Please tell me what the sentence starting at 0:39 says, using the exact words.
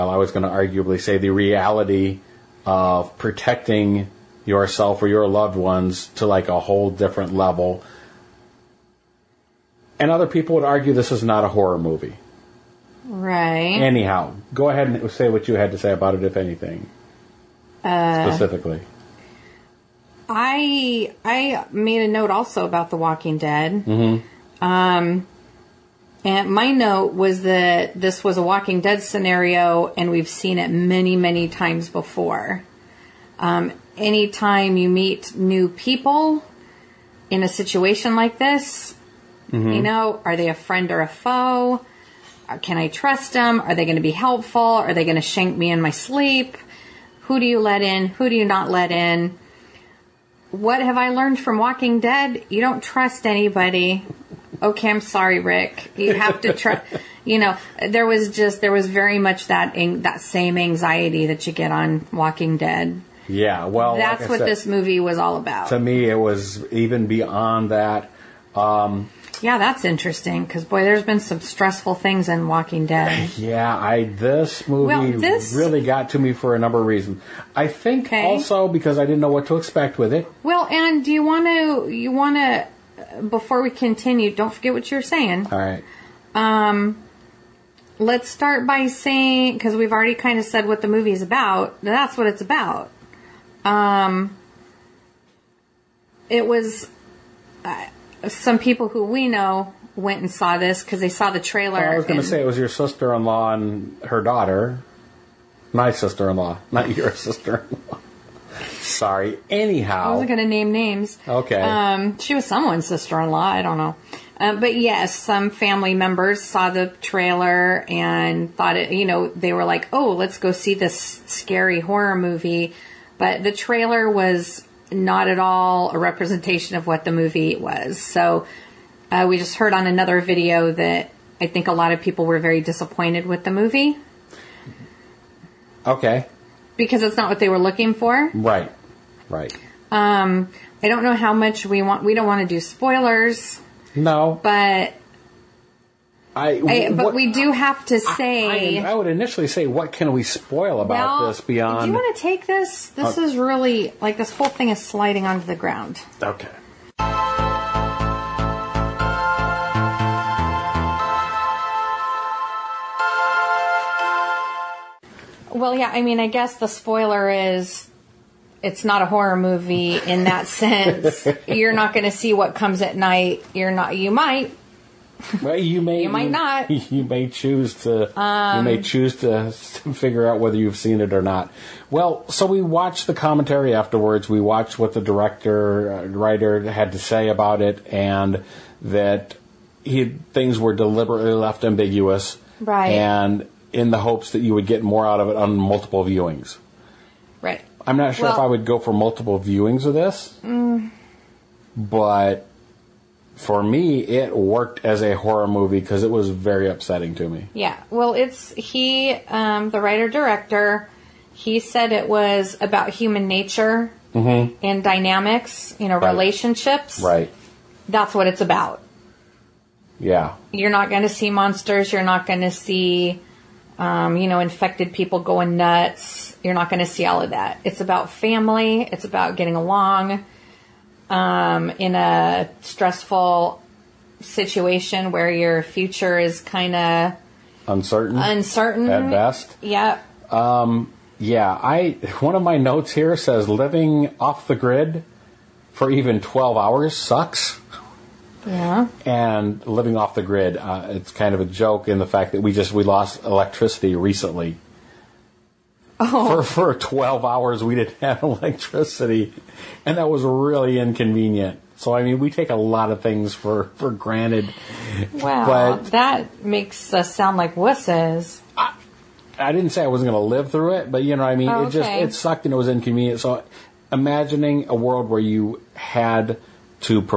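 you know, are they a friend or a foe?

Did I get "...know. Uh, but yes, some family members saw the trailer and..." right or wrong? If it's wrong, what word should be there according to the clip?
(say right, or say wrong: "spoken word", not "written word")
right.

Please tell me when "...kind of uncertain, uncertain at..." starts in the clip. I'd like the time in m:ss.
3:56.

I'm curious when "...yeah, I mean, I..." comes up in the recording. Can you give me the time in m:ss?
2:45.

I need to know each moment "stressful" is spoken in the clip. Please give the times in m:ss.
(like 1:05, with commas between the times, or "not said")
1:11, 3:52.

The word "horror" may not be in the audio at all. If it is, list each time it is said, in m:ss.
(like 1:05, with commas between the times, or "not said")
0:11, 2:01, 2:49, 3:25.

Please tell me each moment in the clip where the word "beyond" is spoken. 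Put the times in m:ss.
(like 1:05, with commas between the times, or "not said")
1:07, 2:31.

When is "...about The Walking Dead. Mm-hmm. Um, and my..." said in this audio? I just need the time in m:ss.
0:22.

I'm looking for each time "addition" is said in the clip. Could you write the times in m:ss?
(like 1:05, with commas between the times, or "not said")
not said.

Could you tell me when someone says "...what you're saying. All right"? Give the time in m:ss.
1:24.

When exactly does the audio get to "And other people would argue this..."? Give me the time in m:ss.
0:09.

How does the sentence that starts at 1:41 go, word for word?
Well, I was going to say it was your sister in law and her daughter.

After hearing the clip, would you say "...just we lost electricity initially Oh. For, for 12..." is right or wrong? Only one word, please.
wrong.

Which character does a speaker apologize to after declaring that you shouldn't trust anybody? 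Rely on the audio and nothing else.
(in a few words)
Rick.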